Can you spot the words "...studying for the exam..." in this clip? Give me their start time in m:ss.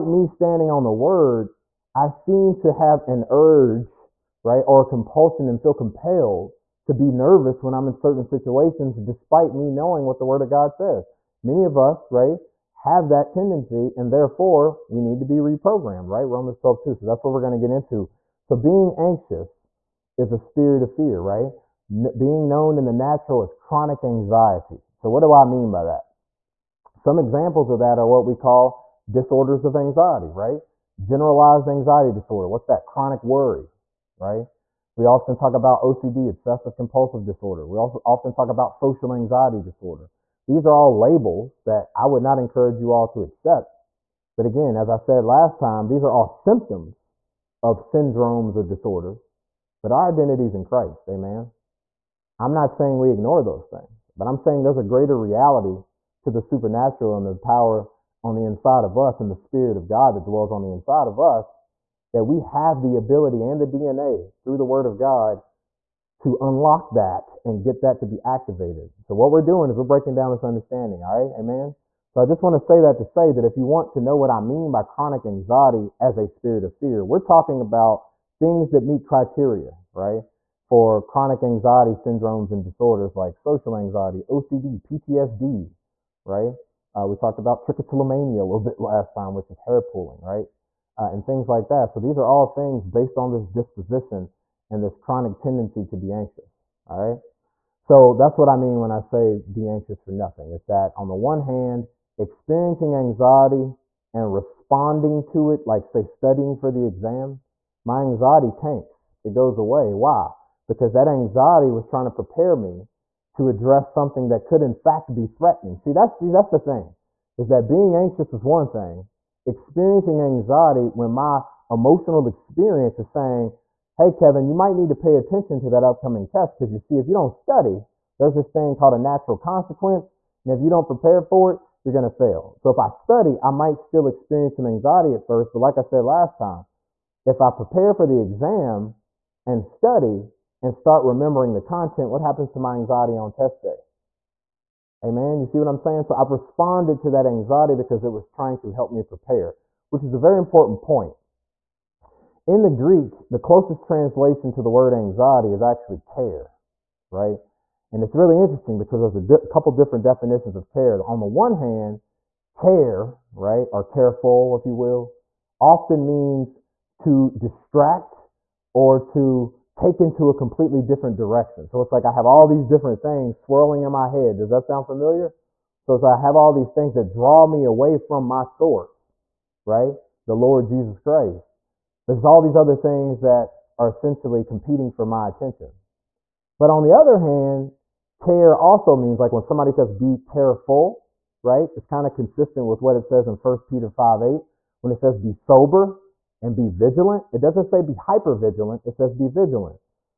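1:46.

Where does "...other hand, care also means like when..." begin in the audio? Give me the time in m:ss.
3:06.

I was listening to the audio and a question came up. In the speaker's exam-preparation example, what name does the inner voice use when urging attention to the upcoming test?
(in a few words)
Kevin.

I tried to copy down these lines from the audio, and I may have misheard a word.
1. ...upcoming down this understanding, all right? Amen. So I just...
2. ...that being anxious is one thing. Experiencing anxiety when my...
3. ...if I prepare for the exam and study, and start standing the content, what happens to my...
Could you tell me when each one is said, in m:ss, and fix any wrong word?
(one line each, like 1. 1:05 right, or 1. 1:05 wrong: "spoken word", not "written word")
1. 1:09 wrong: "breaking", not "upcoming"
2. 1:57 right
3. 2:17 wrong: "remembering", not "standing".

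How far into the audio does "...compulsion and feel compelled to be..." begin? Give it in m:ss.
0:04.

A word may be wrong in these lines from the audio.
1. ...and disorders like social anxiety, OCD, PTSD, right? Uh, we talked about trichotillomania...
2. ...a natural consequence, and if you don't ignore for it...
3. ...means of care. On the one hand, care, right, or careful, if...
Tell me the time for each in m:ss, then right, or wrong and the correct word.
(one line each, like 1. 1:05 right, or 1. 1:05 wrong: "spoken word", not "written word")
1. 1:22 right
2. 2:08 wrong: "prepare", not "ignore"
3. 2:40 wrong: "definitions", not "means".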